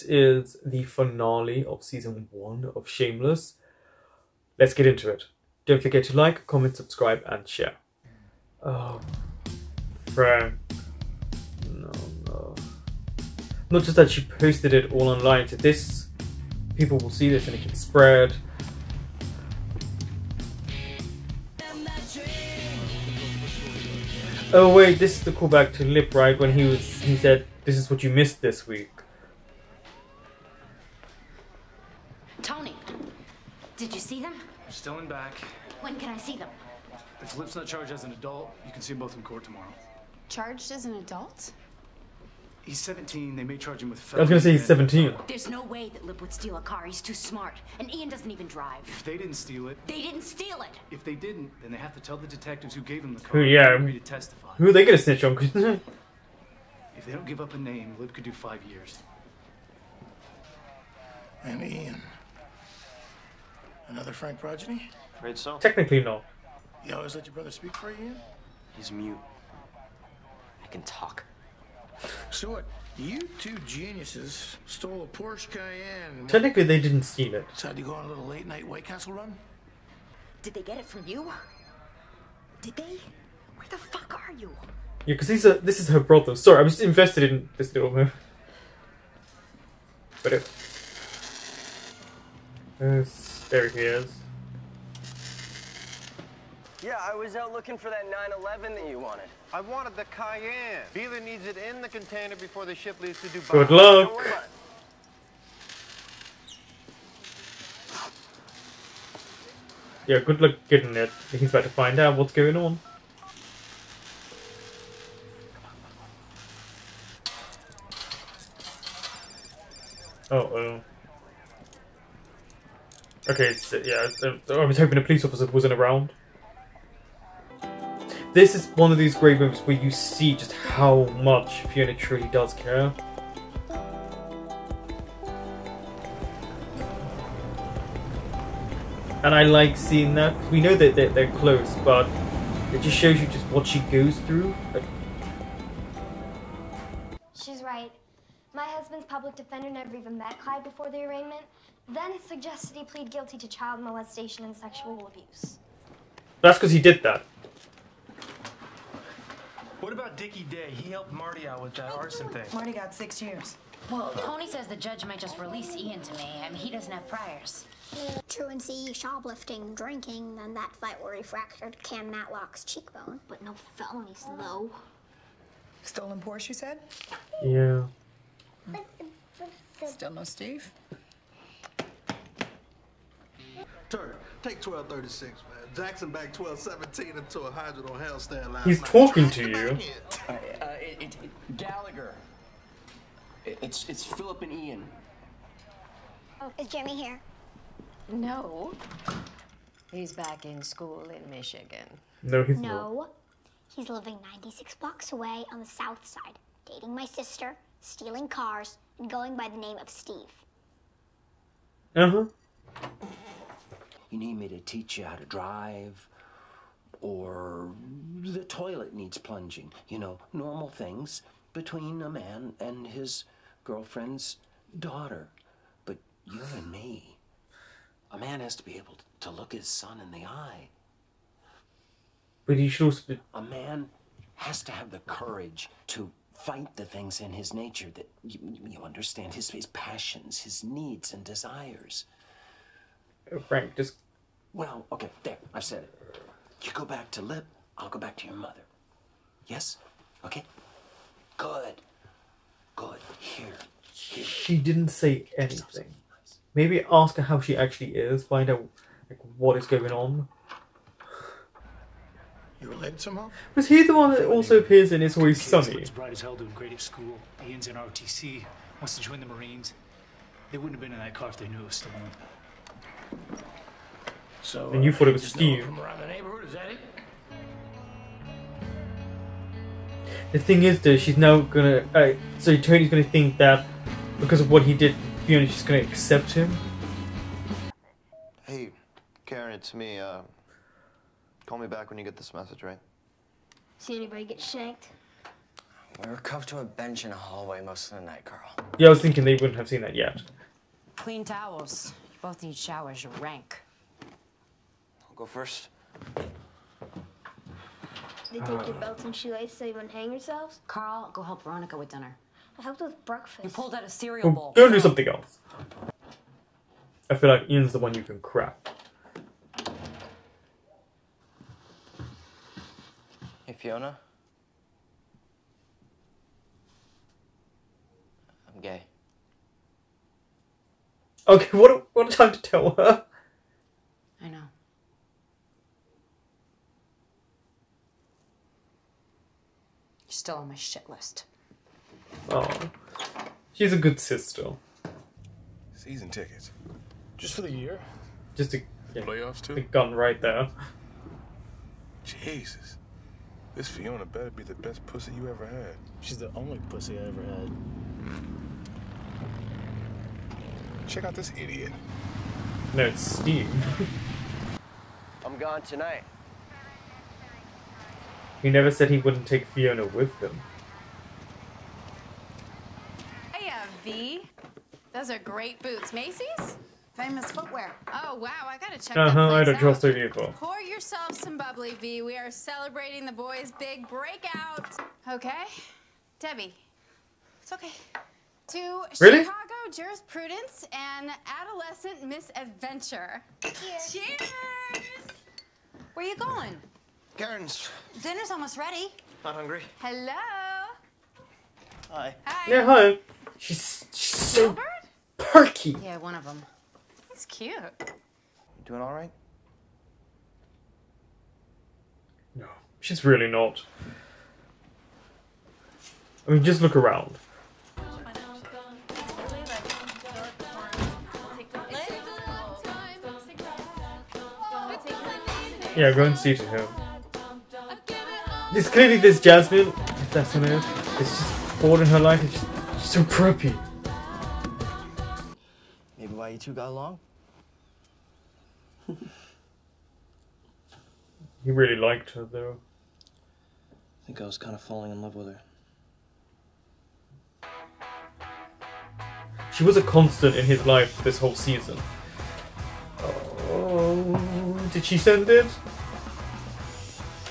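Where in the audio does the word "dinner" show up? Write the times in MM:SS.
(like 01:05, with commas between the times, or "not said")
05:11, 06:38.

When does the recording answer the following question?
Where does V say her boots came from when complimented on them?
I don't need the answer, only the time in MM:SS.
06:16.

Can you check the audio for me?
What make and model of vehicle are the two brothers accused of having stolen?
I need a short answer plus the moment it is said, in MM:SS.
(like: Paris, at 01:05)
Porsche Cayenne, at 01:15.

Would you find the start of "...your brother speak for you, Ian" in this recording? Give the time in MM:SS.
01:07.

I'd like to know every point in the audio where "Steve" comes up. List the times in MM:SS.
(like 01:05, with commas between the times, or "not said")
03:00, 03:29, 04:35, 06:03.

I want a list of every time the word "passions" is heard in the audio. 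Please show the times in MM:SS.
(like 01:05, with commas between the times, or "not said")
03:59.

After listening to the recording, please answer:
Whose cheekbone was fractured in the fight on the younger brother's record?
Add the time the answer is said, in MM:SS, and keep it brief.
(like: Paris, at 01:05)
Cam Matlock, at 02:51.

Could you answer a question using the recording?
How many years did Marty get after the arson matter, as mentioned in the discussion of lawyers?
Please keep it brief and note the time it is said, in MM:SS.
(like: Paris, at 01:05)
6 years, at 02:42.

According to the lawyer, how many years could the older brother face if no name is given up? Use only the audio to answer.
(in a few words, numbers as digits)
5 years.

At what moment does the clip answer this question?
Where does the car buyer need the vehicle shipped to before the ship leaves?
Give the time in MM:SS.
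01:43.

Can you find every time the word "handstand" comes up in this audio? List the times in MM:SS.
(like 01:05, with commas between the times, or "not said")
03:07.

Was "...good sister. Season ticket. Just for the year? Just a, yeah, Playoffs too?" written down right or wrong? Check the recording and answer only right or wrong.
right.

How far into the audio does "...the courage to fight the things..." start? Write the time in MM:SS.
03:54.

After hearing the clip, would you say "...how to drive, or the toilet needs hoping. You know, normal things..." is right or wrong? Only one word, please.
wrong.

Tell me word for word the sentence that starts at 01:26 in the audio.
Sorry, I'm just invested in this little move.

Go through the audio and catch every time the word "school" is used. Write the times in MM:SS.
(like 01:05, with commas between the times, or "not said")
03:20, 04:26.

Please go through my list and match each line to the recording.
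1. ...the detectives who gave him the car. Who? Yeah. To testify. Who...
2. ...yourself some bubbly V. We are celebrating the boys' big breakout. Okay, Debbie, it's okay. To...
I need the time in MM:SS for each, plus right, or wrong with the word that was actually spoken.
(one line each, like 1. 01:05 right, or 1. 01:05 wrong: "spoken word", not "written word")
1. 00:52 right
2. 06:20 right.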